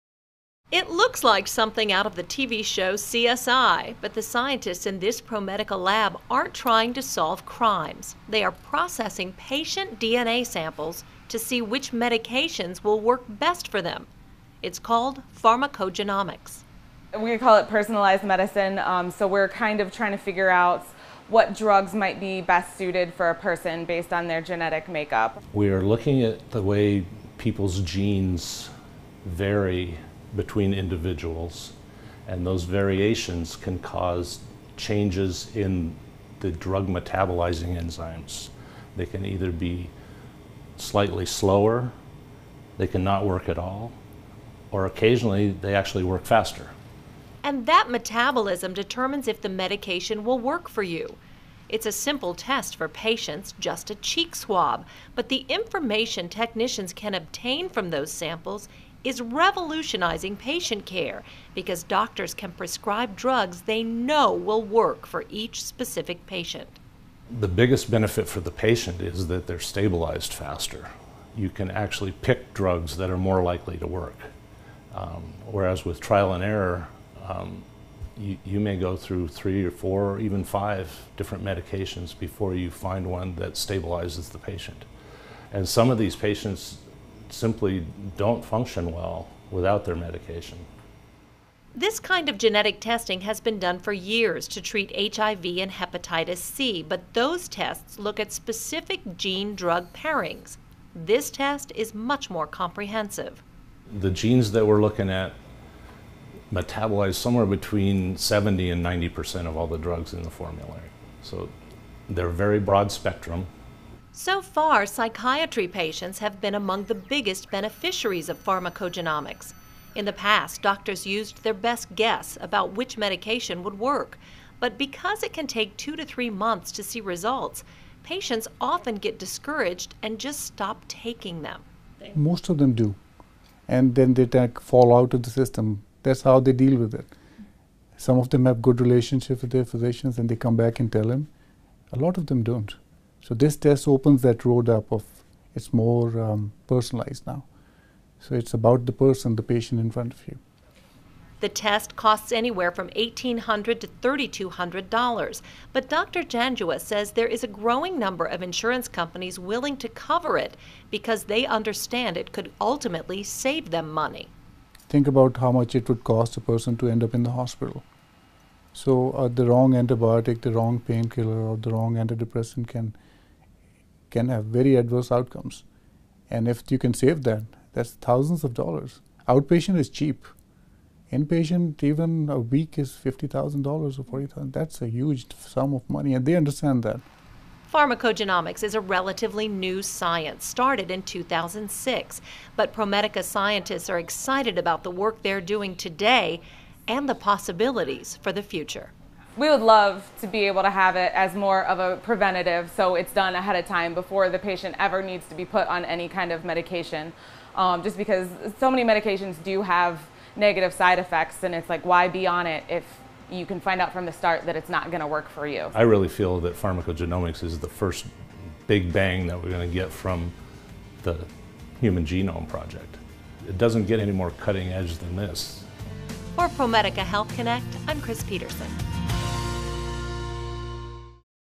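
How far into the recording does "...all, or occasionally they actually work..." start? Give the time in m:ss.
0:43.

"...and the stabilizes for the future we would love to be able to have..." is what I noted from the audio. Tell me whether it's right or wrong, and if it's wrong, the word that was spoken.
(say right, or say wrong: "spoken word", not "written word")
wrong: "possibilities", not "stabilizes".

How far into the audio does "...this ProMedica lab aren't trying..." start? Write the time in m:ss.
0:04.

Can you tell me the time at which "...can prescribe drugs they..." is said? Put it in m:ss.
1:02.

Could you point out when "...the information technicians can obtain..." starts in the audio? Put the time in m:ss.
0:55.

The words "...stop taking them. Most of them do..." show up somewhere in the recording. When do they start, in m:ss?
2:10.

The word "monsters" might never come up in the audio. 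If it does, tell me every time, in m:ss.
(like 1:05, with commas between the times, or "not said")
not said.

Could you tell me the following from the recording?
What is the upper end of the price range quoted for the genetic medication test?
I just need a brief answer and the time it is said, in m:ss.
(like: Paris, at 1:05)
$3,200, at 2:33.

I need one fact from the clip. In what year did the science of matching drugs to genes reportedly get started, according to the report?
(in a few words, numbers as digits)
2006.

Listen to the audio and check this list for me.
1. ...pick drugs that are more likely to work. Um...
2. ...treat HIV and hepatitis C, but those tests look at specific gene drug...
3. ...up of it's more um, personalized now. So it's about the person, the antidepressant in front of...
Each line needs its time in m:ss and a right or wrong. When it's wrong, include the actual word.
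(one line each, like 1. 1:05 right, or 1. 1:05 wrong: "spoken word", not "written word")
1. 1:12 right
2. 1:34 right
3. 2:24 wrong: "patient", not "antidepressant".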